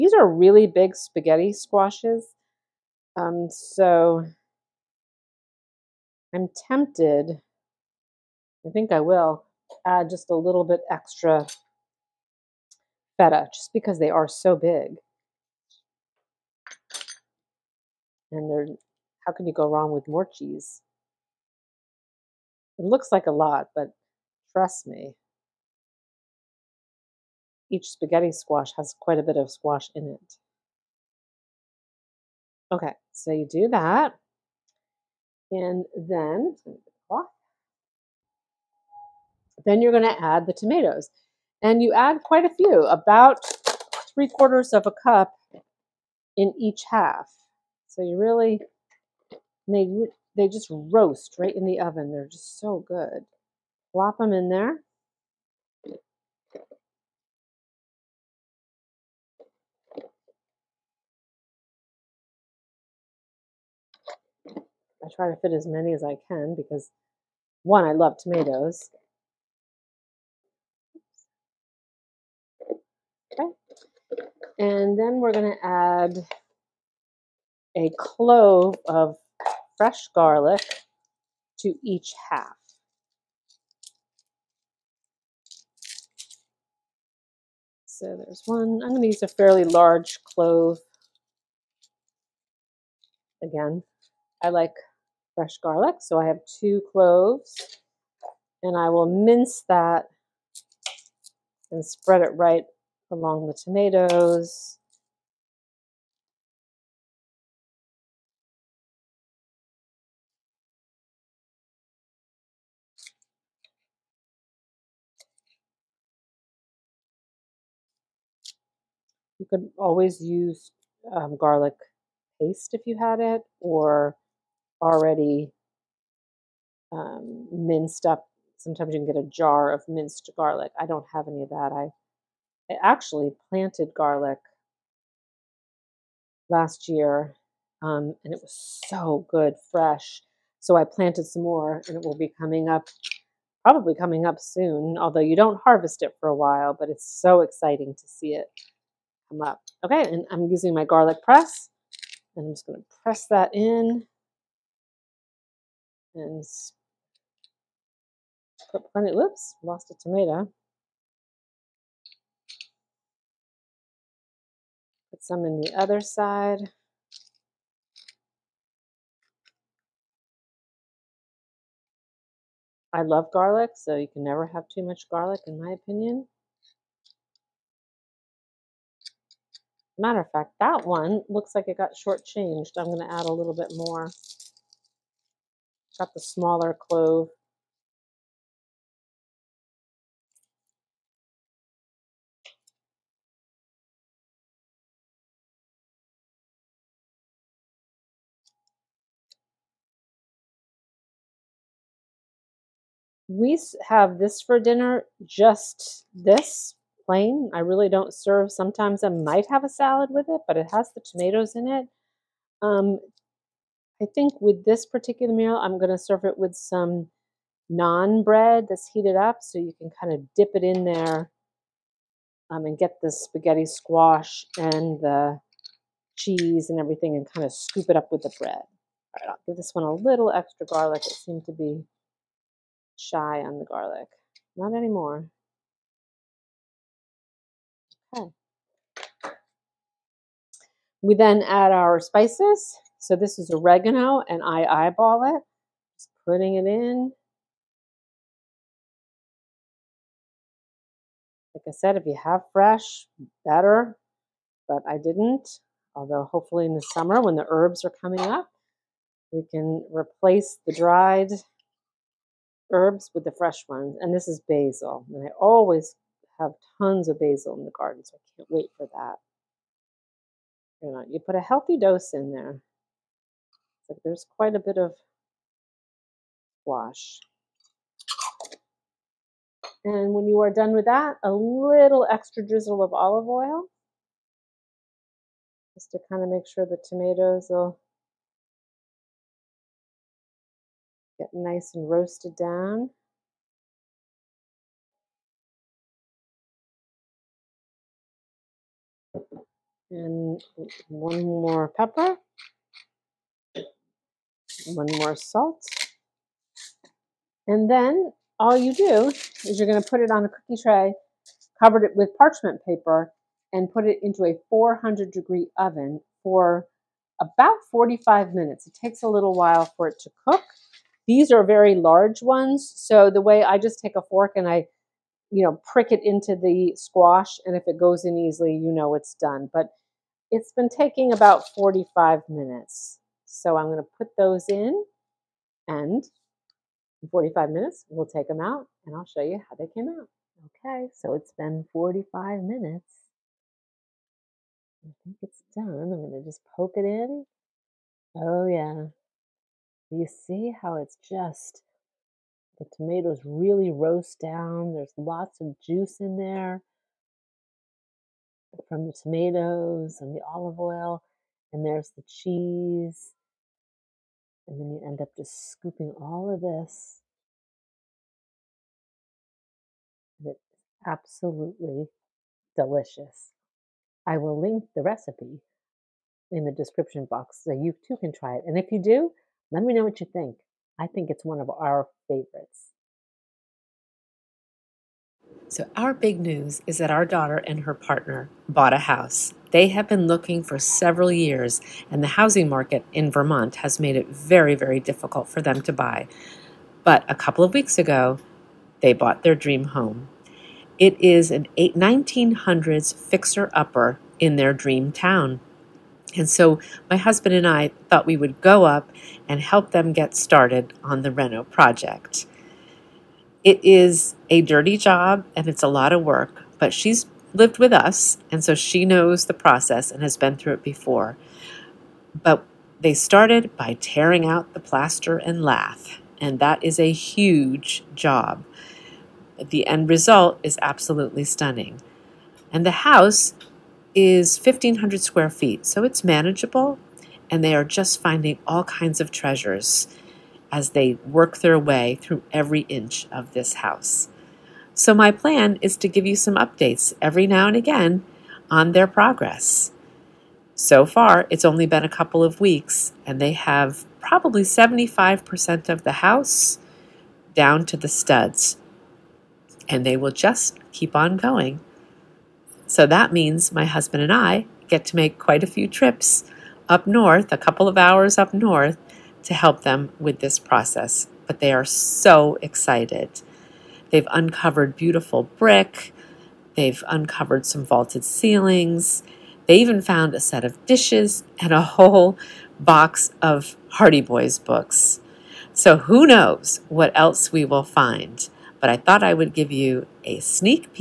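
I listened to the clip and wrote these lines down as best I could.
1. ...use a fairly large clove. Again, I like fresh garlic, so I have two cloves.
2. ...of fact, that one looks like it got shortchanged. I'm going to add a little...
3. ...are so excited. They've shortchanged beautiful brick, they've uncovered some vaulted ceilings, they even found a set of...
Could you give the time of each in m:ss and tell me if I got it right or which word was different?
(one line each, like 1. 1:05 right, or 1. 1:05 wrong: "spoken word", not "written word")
1. 1:29 right
2. 3:00 right
3. 7:51 wrong: "uncovered", not "shortchanged".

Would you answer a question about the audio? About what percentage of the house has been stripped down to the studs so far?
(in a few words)
75%.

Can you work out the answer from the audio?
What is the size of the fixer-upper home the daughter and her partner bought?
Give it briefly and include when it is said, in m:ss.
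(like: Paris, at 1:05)
1,500 square feet, at 7:14.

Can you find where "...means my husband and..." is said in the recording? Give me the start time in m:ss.
7:43.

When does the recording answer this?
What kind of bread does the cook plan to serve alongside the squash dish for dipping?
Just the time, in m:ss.
3:37.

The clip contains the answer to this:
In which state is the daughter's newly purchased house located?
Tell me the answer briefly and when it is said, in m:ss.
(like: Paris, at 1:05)
Vermont, at 6:33.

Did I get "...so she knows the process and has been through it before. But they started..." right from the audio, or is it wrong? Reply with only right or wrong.
right.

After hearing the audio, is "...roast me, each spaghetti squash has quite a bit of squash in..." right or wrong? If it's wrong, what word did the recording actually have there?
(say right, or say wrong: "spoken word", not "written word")
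wrong: "trust", not "roast".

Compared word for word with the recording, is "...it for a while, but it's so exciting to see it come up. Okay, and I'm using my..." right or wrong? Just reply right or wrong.
right.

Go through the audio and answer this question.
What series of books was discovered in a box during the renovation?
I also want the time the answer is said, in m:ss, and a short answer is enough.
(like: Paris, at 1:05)
Hardy Boys, at 8:03.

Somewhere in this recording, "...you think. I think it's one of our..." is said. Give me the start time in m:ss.
6:19.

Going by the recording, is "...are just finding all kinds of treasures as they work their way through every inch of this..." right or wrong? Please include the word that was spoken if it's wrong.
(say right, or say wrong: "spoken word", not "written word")
right.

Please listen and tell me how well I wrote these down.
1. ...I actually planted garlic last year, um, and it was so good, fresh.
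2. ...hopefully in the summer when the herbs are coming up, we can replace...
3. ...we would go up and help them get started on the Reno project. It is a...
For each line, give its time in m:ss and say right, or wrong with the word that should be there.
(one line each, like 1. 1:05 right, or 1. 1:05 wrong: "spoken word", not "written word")
1. 2:12 right
2. 4:16 right
3. 6:48 right.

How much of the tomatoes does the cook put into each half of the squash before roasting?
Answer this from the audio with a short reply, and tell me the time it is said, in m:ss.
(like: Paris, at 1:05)
3/4 cup, at 0:44.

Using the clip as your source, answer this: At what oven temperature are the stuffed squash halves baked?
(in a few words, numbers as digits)
400 degrees.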